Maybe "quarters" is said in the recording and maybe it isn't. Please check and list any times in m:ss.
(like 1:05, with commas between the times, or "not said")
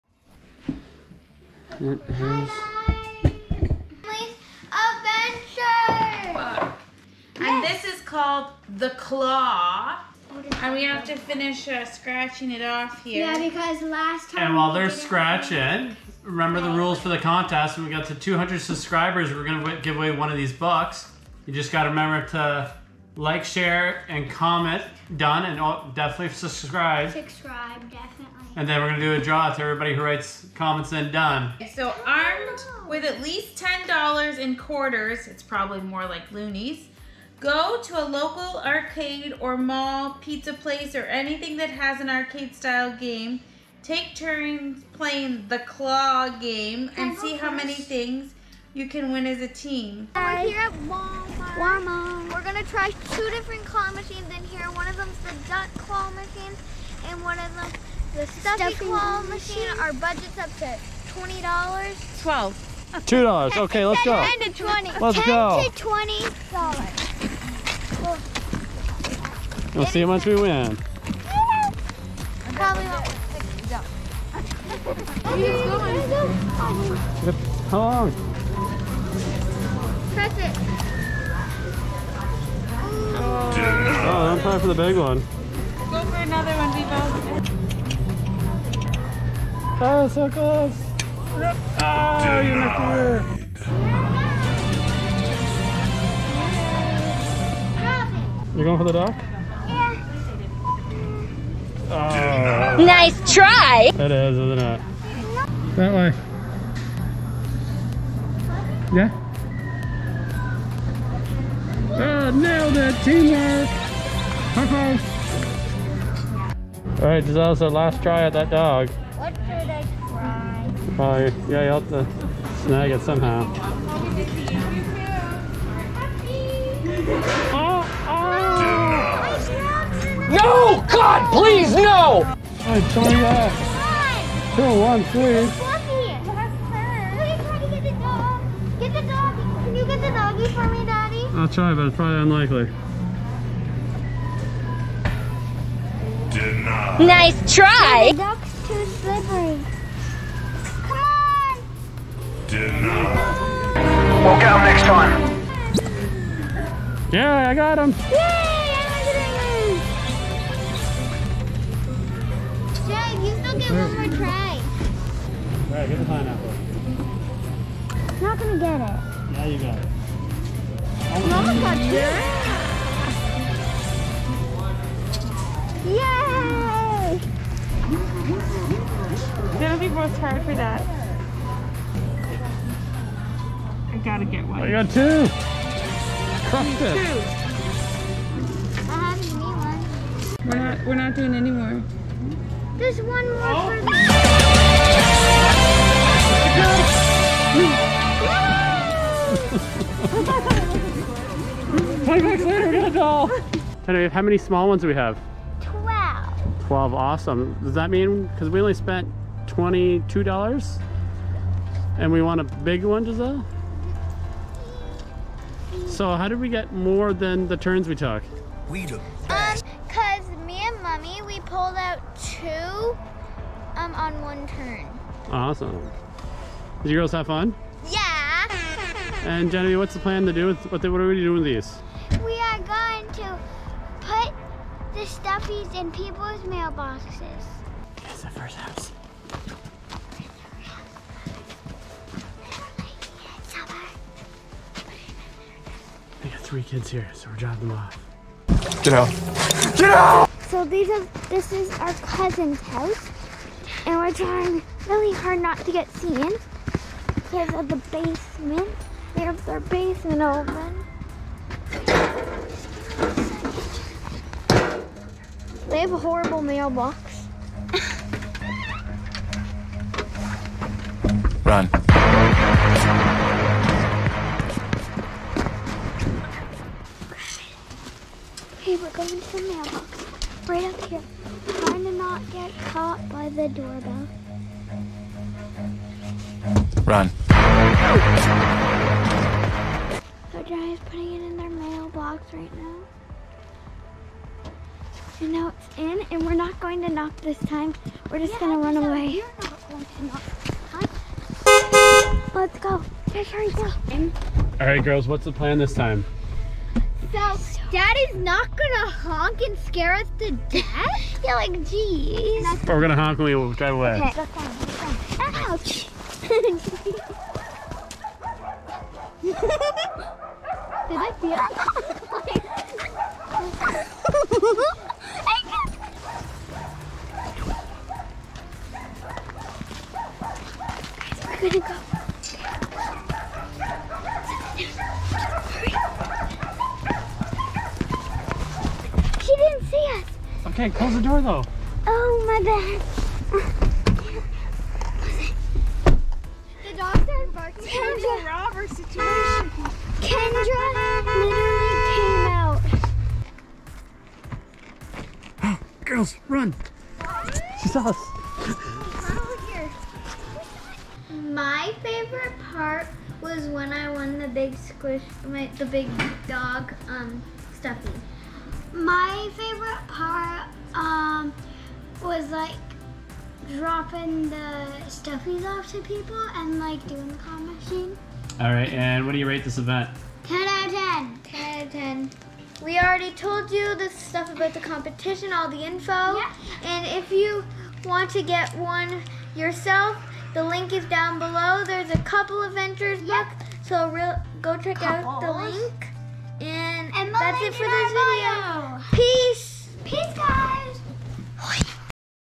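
0:34.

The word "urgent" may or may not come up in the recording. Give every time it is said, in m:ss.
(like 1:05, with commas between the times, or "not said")
not said.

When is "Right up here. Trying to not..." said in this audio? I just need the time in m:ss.
4:40.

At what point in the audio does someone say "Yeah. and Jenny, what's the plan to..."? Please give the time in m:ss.
3:47.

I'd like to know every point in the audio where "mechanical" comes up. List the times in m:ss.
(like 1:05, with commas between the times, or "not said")
not said.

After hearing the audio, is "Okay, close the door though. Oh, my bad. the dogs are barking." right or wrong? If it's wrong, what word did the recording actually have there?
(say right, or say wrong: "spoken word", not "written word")
right.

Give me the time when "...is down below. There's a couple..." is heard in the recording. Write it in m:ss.
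6:30.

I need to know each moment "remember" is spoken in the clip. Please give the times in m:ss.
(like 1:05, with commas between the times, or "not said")
0:16, 0:21.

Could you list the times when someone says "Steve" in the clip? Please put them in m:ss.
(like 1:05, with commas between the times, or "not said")
not said.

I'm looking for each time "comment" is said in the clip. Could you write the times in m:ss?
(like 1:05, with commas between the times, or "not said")
0:24, 0:30.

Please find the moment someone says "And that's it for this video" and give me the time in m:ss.
6:36.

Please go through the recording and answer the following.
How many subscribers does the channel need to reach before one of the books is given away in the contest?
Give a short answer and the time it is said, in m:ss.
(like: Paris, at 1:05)
200, at 0:18.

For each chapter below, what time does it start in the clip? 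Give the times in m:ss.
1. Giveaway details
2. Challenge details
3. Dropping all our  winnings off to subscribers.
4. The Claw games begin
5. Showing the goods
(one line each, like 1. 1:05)
1. 0:13
2. 0:31
3. 3:57
4. 1:14
5. 3:23.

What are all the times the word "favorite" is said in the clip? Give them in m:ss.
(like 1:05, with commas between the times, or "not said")
6:01, 6:09.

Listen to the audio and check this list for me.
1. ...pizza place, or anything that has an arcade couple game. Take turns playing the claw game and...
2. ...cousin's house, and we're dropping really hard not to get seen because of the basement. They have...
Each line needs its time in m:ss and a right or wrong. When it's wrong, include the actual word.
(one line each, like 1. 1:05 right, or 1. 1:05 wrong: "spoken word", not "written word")
1. 0:40 wrong: "style", not "couple"
2. 4:11 wrong: "trying", not "dropping".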